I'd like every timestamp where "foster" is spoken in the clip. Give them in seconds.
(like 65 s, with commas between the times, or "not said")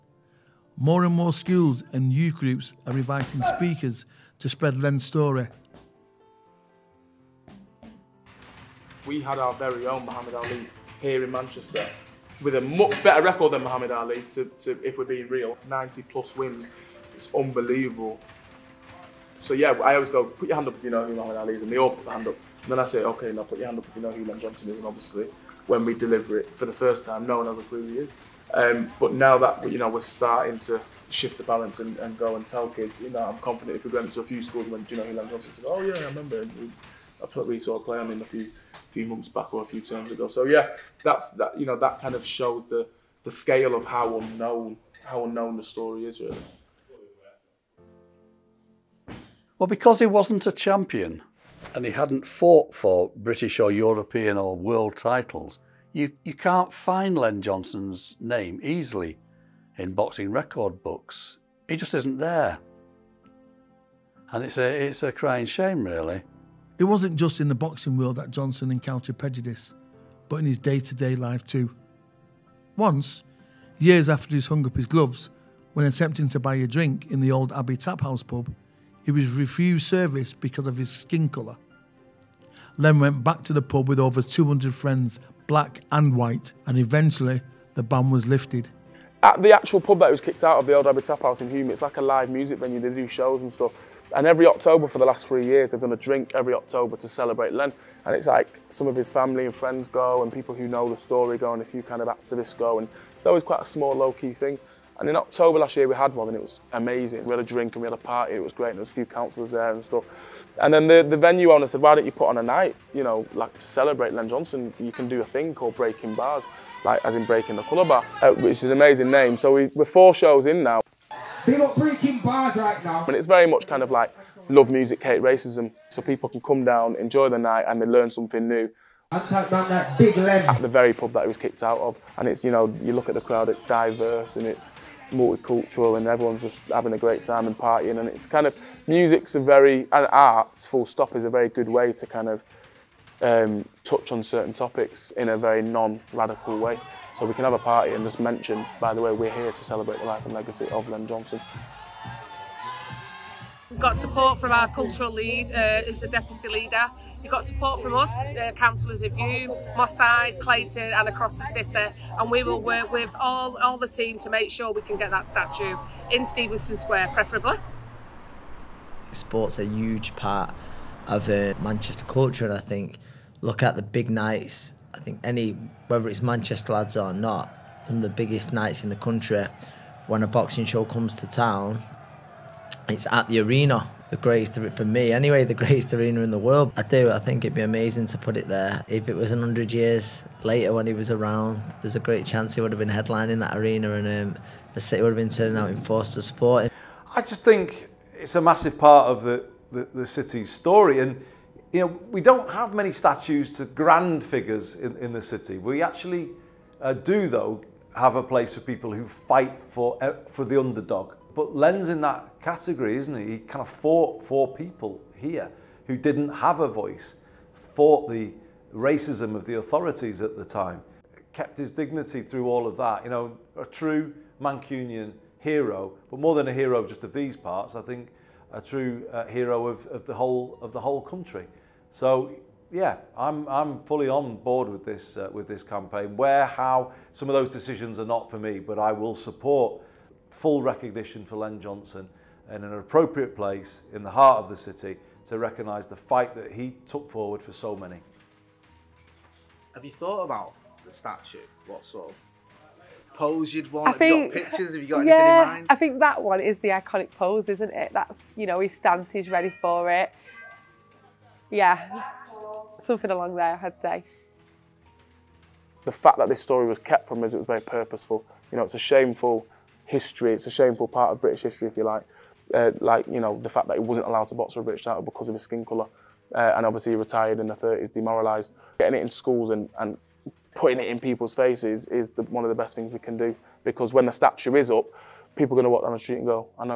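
not said.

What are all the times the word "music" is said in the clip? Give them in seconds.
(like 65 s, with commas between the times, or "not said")
92 s, 124 s, 138 s.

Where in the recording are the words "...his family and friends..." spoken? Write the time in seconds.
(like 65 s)
98 s.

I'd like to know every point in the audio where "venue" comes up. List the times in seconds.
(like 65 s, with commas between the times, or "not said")
92 s, 111 s.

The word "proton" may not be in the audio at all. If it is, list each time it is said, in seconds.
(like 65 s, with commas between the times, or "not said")
not said.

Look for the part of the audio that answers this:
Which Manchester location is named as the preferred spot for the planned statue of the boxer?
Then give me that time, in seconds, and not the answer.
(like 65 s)
166 s.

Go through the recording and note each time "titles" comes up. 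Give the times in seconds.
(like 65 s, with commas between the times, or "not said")
54 s, 274 s.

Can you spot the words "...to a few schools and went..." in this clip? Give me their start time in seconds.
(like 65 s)
34 s.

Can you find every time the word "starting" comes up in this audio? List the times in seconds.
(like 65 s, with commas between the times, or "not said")
30 s.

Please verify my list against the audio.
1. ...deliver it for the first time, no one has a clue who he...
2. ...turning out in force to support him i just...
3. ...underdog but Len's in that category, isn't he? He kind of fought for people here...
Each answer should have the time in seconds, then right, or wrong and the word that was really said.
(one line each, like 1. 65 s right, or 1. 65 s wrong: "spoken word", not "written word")
1. 25 s right
2. 195 s right
3. 210 s right.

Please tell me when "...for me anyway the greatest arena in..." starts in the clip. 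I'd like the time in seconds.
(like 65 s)
184 s.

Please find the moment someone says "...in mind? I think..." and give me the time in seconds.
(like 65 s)
255 s.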